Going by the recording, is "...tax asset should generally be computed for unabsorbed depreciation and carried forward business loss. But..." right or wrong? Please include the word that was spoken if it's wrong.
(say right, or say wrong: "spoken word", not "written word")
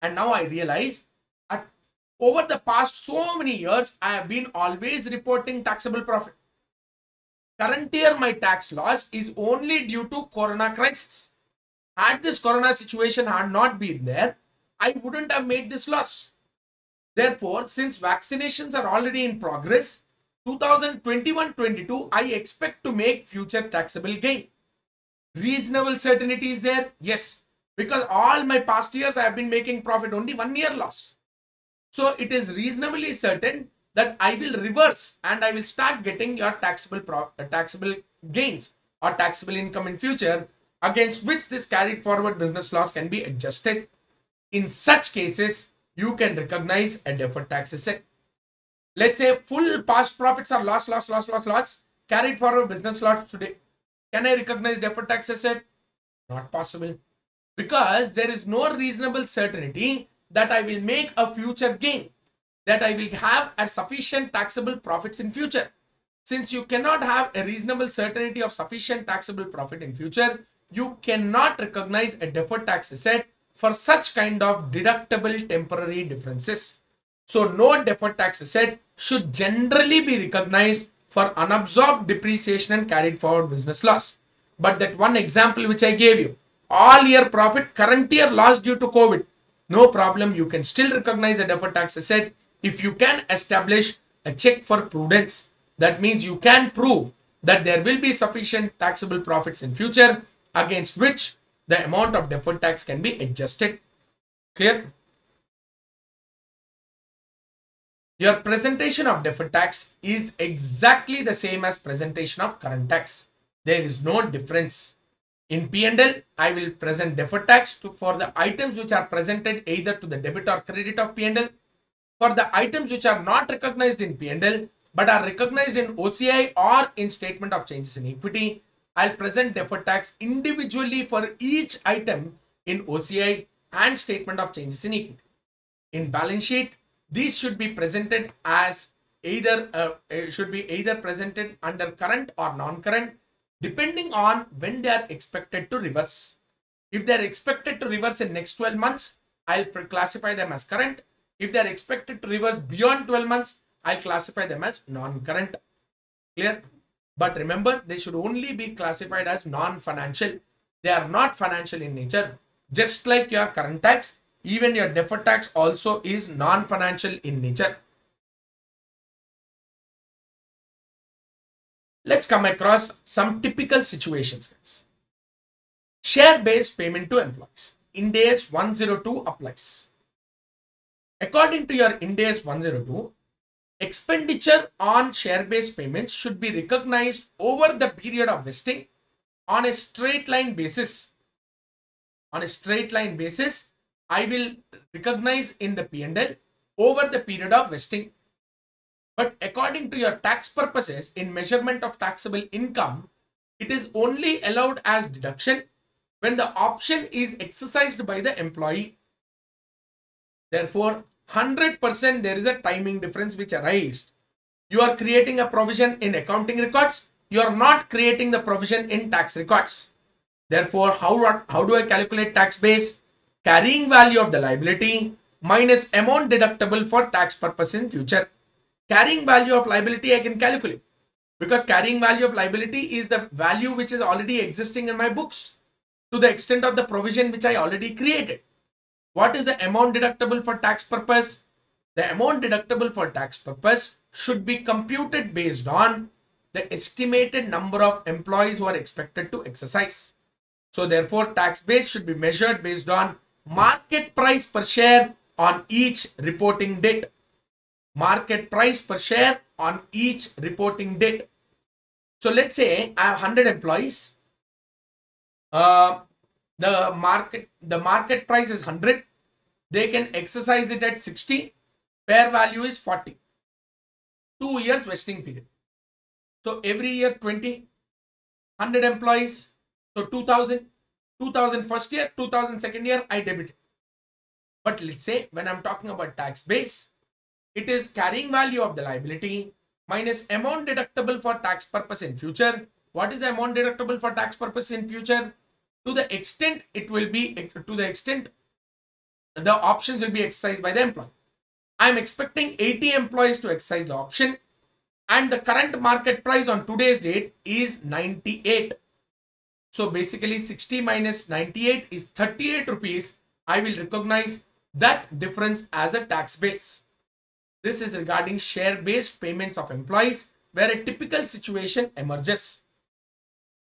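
wrong: "recognized", not "computed".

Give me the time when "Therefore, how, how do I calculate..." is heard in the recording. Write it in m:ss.
3:40.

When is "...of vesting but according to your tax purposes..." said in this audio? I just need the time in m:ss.
3:17.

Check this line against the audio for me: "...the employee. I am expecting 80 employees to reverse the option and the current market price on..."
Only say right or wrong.
wrong.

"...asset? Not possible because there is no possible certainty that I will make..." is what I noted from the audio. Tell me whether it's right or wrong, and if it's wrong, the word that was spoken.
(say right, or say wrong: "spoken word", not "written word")
wrong: "reasonable", not "possible".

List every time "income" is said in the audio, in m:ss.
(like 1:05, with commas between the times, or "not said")
0:39, 3:22.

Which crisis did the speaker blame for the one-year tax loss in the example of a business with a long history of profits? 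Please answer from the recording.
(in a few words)
corona crisis.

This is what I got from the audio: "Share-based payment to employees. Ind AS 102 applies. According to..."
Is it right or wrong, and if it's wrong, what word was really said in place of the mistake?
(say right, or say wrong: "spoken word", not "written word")
right.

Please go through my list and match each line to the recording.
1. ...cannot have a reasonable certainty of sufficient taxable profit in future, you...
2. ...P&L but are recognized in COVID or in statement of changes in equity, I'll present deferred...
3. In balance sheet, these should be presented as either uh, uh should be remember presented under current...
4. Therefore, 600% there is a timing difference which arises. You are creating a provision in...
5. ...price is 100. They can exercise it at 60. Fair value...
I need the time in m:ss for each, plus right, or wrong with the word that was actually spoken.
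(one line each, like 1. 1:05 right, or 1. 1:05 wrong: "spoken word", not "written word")
1. 1:06 right
2. 2:04 wrong: "OCI", not "COVID"
3. 2:15 wrong: "either", not "remember"
4. 3:30 wrong: "100", not "600"
5. 4:28 right.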